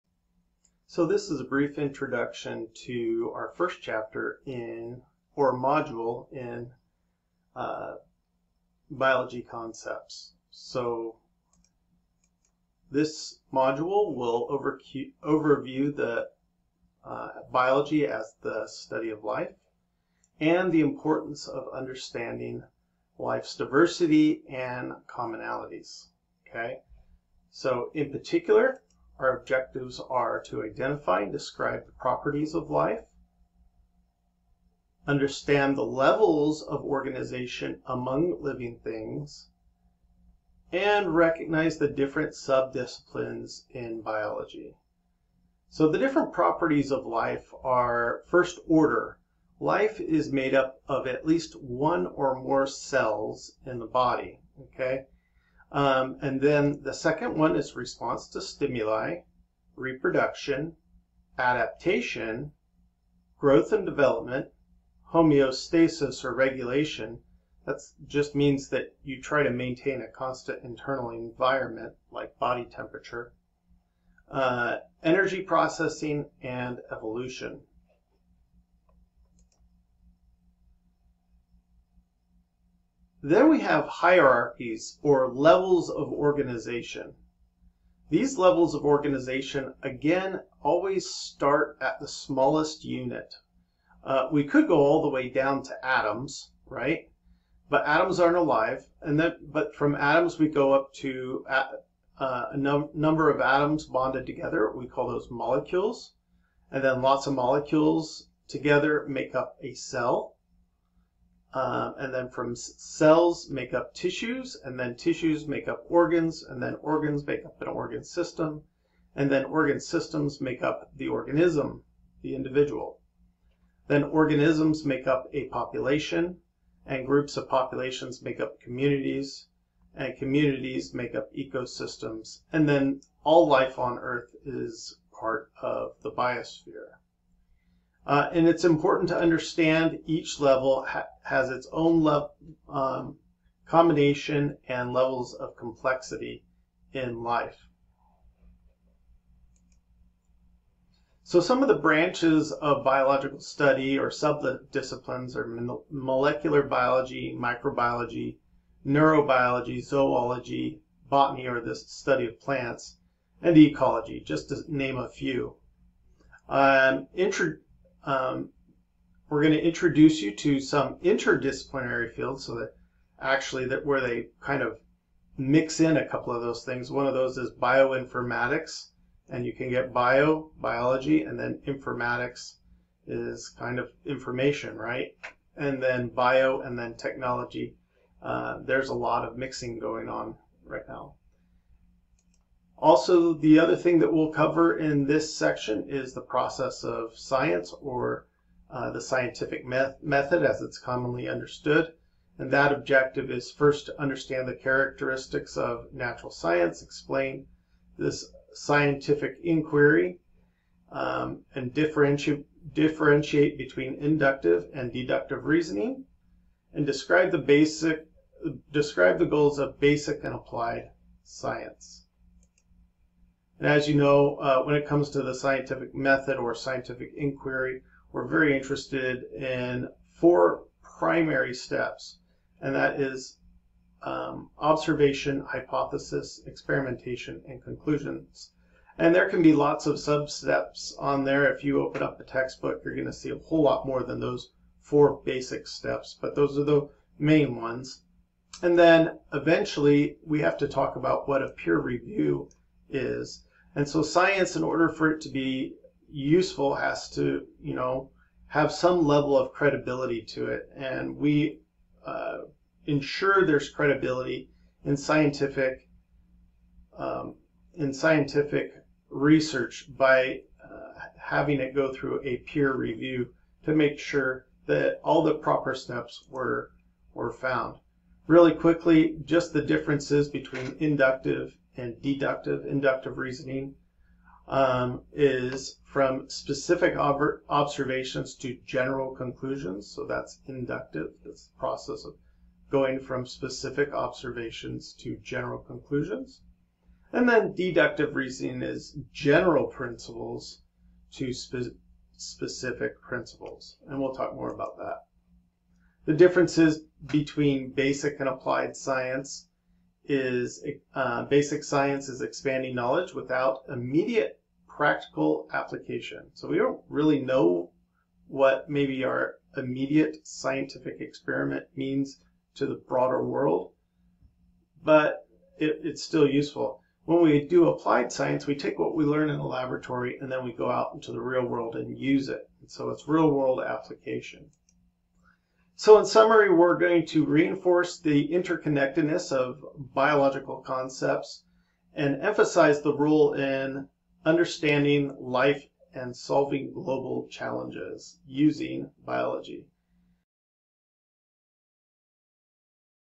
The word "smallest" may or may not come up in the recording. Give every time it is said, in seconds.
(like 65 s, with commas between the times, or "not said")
92 s.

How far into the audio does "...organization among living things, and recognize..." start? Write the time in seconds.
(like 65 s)
36 s.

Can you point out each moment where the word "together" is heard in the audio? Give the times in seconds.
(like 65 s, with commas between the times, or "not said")
104 s, 108 s.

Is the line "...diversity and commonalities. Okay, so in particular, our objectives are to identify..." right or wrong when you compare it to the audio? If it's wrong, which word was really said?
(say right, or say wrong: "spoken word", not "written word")
right.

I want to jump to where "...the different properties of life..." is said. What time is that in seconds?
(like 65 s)
45 s.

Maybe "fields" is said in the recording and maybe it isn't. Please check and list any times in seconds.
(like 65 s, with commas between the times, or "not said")
172 s.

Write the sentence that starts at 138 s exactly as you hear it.
Uh, and it's important to understand each level ha has its own um, combination and levels of complexity in life.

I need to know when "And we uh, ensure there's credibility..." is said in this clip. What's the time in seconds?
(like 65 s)
260 s.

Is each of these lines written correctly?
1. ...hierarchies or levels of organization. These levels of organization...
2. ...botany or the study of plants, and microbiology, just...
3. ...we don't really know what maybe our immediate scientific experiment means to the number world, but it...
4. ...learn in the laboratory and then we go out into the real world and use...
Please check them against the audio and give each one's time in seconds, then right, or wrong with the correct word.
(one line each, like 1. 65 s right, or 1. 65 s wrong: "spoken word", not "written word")
1. 83 s right
2. 161 s wrong: "ecology", not "microbiology"
3. 316 s wrong: "broader", not "number"
4. 329 s right.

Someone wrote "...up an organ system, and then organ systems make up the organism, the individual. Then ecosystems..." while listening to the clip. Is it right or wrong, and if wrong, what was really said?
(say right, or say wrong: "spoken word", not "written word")
wrong: "organisms", not "ecosystems".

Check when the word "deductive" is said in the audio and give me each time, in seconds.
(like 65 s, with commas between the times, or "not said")
214 s, 282 s, 297 s.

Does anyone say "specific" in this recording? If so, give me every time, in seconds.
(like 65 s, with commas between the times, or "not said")
286 s, 293 s, 302 s.